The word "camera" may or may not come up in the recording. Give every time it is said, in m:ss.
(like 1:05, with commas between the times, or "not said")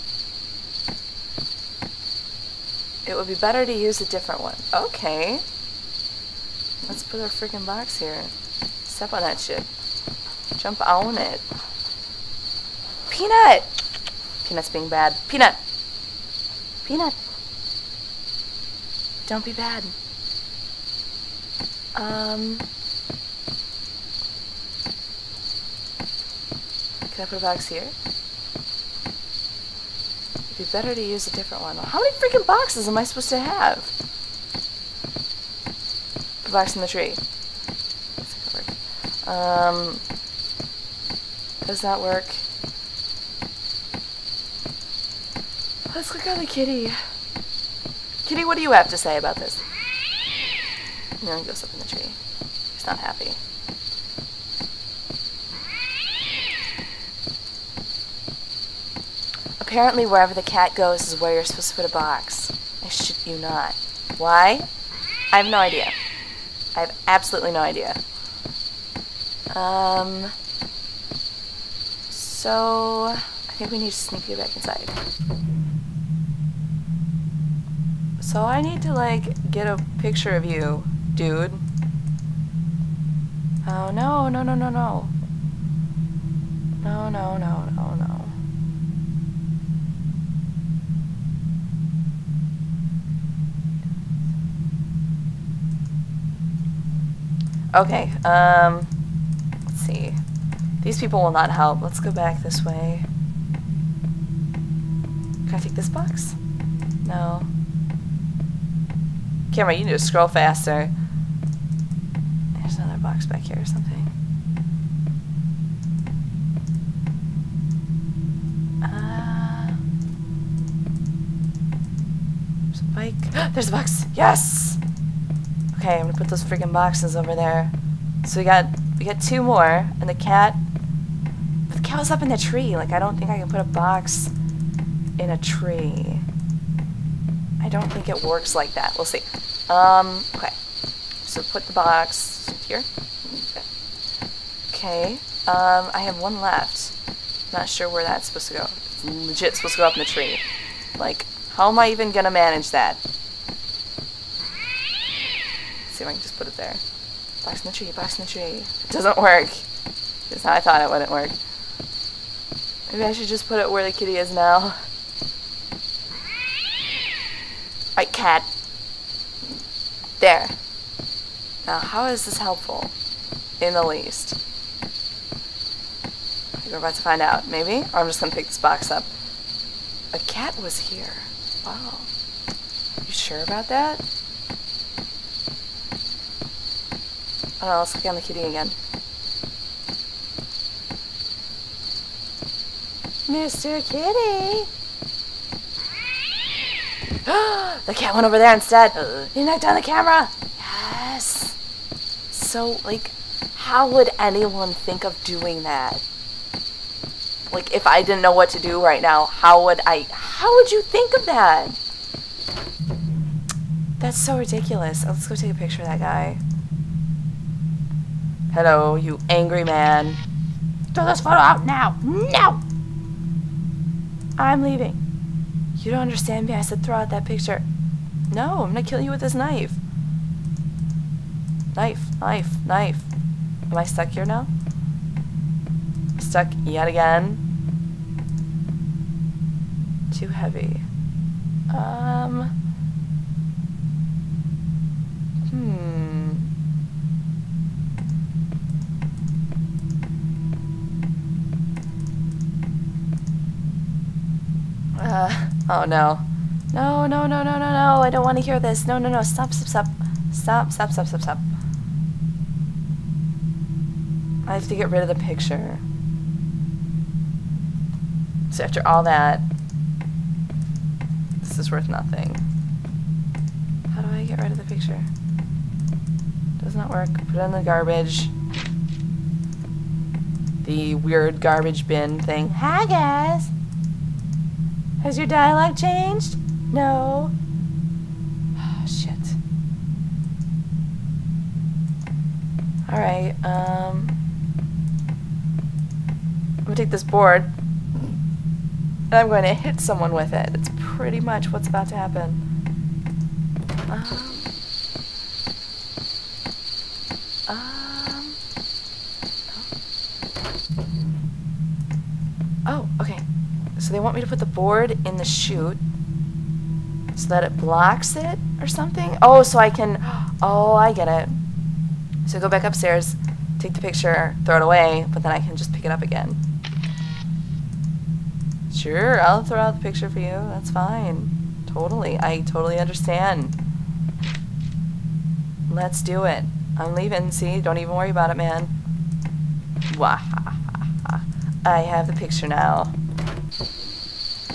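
1:49, 3:19.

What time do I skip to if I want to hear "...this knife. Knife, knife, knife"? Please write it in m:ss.
3:49.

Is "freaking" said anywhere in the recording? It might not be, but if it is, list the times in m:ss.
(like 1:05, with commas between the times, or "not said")
0:07, 0:32, 2:06.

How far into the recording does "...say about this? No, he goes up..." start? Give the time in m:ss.
0:48.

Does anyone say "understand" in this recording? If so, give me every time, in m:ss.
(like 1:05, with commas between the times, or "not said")
3:45, 5:32.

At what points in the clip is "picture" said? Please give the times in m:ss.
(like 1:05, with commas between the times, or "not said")
1:19, 3:35, 3:47, 4:25, 4:34, 5:23, 5:29, 5:42.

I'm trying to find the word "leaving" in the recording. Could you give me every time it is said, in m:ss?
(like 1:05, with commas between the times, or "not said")
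3:44, 5:36.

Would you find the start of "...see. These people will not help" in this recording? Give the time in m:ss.
1:39.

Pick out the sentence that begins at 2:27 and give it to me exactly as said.
Not sure where that's supposed to go.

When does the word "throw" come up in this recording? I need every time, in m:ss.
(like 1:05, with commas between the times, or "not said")
3:40, 3:46, 5:24, 5:29.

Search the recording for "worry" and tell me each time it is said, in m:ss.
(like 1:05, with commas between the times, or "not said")
5:37.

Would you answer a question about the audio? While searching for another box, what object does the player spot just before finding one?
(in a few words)
A bike.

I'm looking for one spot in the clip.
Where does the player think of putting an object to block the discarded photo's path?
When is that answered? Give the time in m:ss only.
5:15.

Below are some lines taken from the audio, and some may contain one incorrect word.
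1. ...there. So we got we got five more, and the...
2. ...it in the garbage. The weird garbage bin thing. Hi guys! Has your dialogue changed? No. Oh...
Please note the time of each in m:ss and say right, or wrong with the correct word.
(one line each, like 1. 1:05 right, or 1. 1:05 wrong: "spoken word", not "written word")
1. 2:07 wrong: "two", not "five"
2. 4:37 right.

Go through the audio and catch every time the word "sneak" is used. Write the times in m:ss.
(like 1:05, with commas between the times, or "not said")
1:13.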